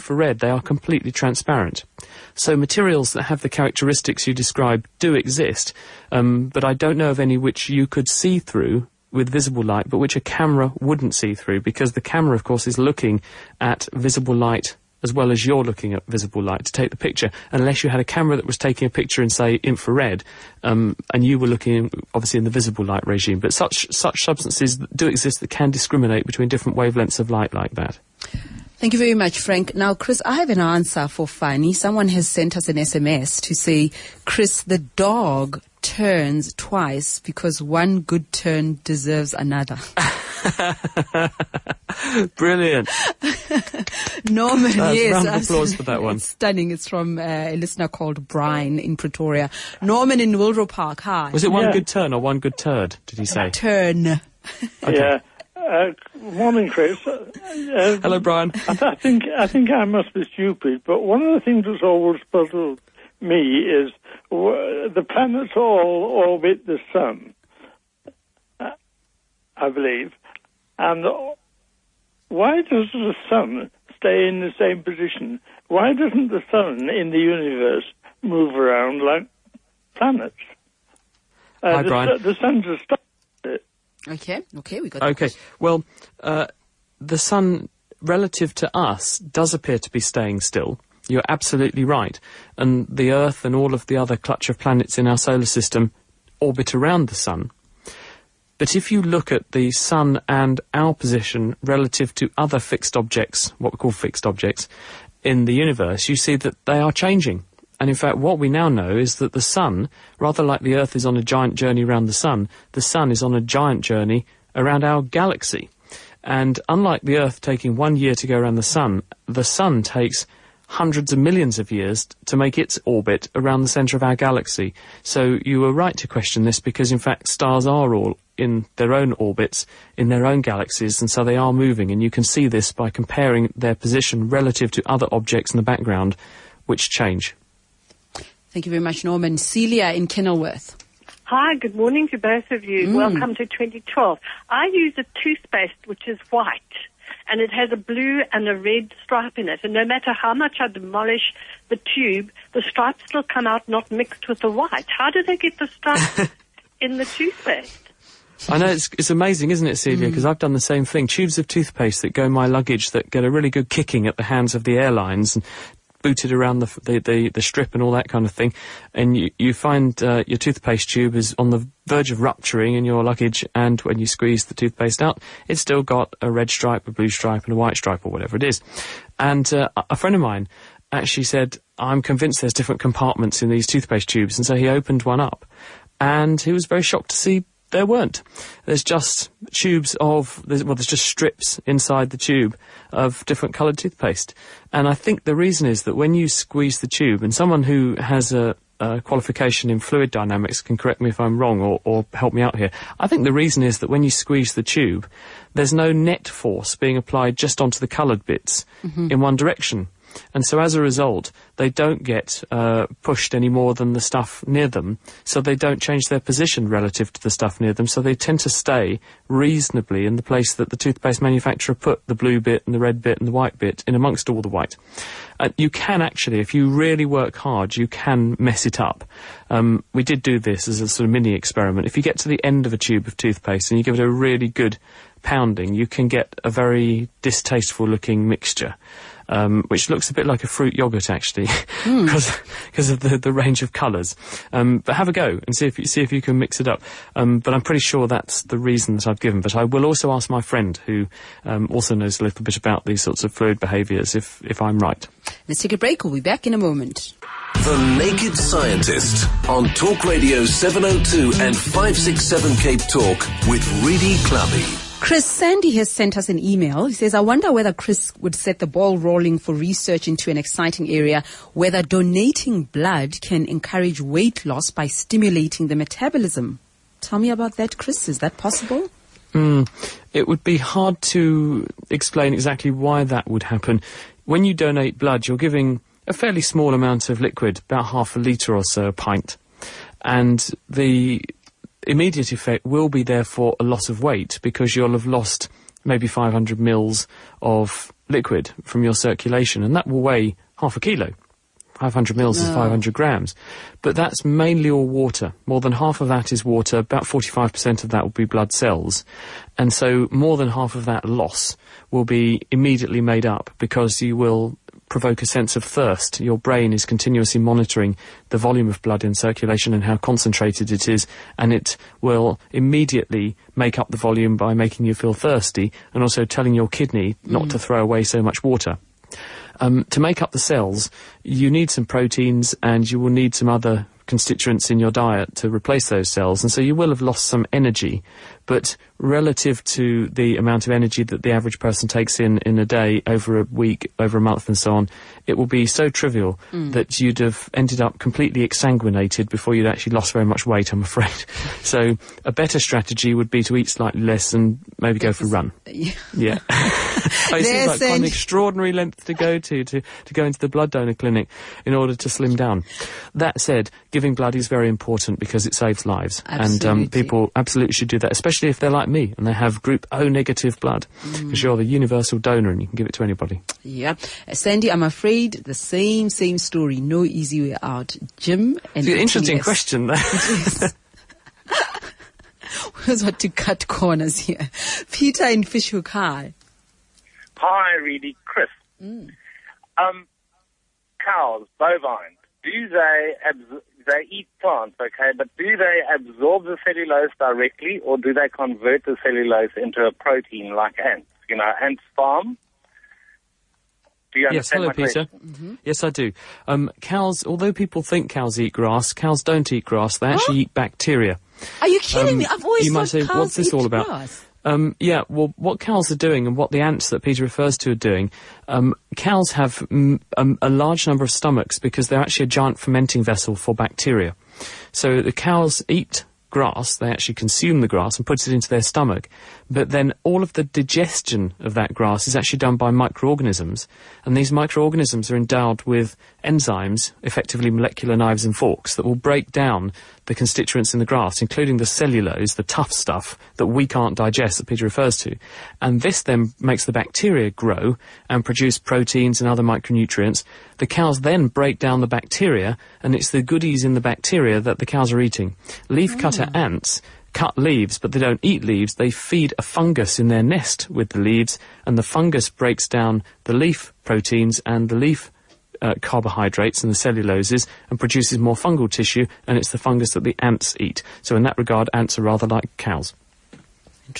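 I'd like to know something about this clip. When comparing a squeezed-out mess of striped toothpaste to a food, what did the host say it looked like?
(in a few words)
fruit yogurt.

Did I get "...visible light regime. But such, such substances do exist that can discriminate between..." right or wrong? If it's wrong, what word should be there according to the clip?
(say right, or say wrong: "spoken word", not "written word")
right.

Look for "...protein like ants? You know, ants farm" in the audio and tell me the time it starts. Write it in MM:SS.
06:39.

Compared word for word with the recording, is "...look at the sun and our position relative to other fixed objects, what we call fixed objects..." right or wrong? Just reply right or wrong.
right.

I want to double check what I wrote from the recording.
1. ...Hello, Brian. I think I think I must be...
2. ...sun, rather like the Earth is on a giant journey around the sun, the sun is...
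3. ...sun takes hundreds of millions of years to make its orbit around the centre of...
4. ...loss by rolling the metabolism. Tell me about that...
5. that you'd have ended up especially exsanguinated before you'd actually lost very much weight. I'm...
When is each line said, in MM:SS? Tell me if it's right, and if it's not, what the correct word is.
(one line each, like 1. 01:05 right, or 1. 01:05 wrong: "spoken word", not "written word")
1. 00:58 right
2. 01:49 right
3. 01:59 right
4. 04:34 wrong: "stimulating", not "rolling"
5. 05:46 wrong: "completely", not "especially".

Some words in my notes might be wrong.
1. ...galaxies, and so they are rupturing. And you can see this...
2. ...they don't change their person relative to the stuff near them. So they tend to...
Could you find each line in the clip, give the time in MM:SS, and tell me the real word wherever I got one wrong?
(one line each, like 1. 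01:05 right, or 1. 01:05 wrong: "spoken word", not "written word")
1. 02:10 wrong: "moving", not "rupturing"
2. 03:35 wrong: "position", not "person".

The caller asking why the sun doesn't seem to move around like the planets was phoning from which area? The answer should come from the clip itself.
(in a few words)
Wilder Park.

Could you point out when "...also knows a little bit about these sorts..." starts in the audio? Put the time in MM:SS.
04:11.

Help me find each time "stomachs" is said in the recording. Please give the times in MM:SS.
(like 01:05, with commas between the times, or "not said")
07:01, 07:08.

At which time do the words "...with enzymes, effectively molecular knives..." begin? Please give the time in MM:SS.
07:15.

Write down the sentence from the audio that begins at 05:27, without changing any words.
to throw away so much water.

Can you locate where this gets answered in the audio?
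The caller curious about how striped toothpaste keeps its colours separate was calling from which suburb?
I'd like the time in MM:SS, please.
02:20.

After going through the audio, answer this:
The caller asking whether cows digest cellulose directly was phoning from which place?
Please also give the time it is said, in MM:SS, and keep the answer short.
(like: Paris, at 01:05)
Fish Hoek, at 06:25.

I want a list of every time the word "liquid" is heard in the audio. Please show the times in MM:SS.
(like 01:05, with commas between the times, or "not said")
04:47, 04:58.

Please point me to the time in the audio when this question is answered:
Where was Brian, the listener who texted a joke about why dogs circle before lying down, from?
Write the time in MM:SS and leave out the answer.
00:48.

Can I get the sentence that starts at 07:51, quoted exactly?
So in that regard, ants are rather like cows.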